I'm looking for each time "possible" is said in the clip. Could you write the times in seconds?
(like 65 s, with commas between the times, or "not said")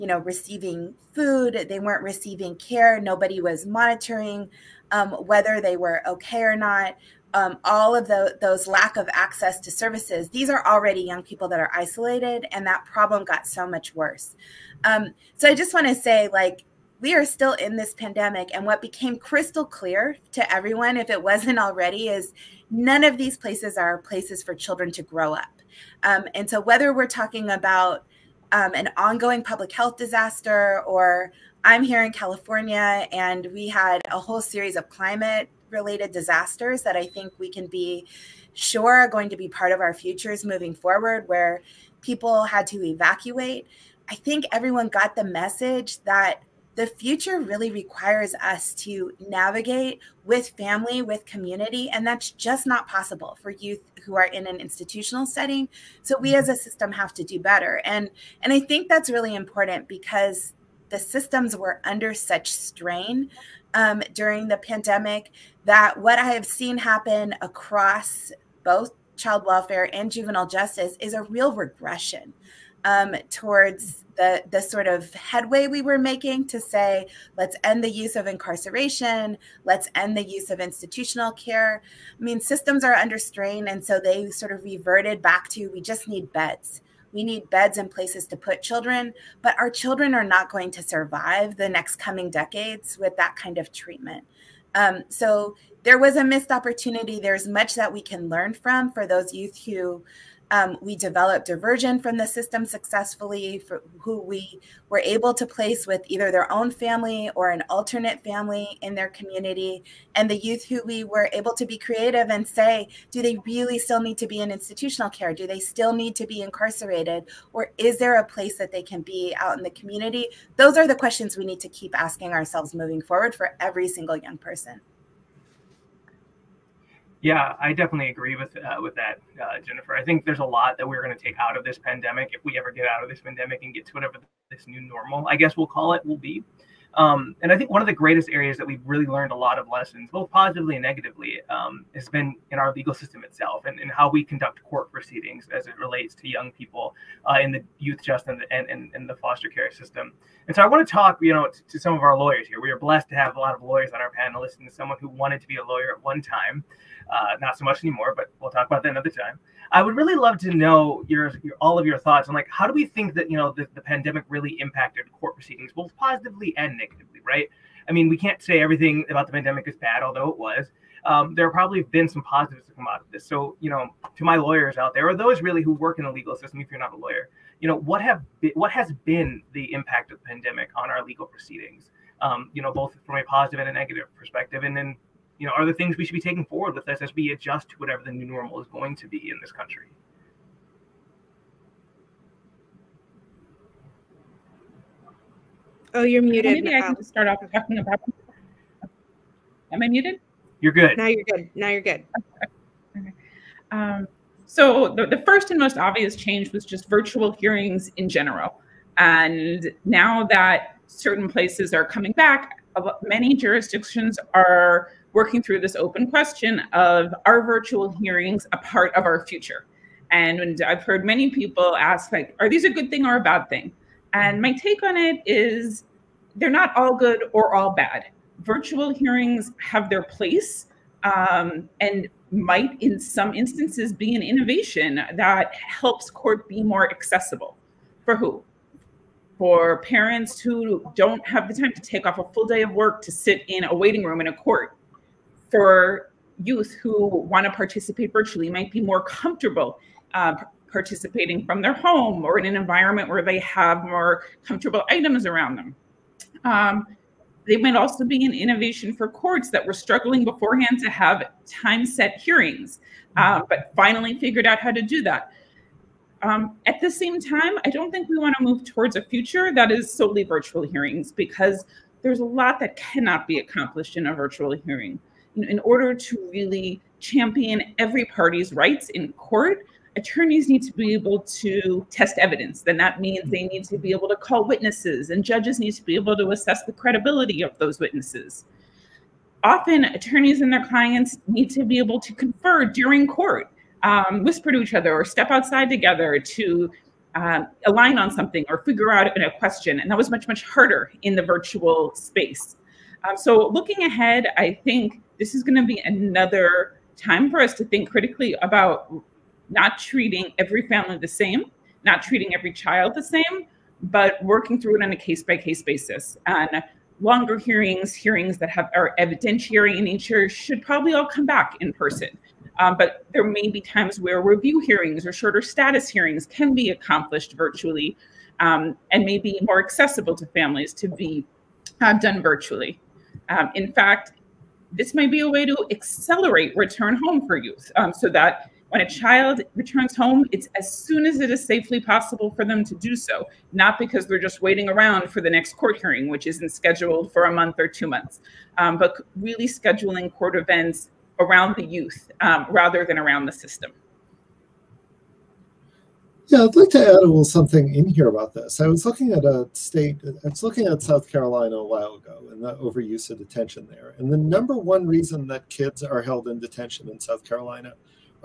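52 s, 341 s.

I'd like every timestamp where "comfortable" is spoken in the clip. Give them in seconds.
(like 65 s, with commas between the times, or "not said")
249 s, 254 s.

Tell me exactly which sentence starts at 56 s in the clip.
So we as a system have to do better.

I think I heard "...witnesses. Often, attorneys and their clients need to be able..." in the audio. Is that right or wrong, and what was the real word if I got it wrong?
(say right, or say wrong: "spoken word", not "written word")
right.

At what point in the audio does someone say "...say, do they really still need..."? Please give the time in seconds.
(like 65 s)
112 s.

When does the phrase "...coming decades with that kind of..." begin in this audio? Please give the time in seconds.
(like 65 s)
91 s.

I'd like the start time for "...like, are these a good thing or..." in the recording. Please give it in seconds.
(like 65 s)
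222 s.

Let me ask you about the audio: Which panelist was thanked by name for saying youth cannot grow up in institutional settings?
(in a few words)
Jennifer.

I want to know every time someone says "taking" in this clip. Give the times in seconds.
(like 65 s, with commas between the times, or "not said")
186 s.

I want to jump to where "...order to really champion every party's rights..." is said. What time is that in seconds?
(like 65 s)
275 s.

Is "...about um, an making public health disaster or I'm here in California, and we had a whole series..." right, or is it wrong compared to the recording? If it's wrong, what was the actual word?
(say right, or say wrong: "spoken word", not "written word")
wrong: "ongoing", not "making".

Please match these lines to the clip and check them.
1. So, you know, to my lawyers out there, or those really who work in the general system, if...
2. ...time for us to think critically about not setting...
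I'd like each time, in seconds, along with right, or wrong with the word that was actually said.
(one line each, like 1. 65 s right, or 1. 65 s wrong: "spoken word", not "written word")
1. 173 s wrong: "legal", not "general"
2. 306 s wrong: "treating", not "setting".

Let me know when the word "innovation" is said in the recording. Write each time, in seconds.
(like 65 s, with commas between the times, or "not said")
234 s, 258 s.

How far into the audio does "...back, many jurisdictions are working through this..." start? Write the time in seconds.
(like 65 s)
212 s.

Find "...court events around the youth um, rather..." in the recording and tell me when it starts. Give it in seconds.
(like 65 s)
350 s.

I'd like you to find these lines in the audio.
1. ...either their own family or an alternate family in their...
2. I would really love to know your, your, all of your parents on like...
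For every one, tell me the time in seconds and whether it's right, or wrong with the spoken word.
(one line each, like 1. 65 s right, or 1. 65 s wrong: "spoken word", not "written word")
1. 106 s right
2. 159 s wrong: "thoughts", not "parents".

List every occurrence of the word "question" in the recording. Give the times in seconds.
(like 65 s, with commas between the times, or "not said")
120 s, 216 s, 299 s.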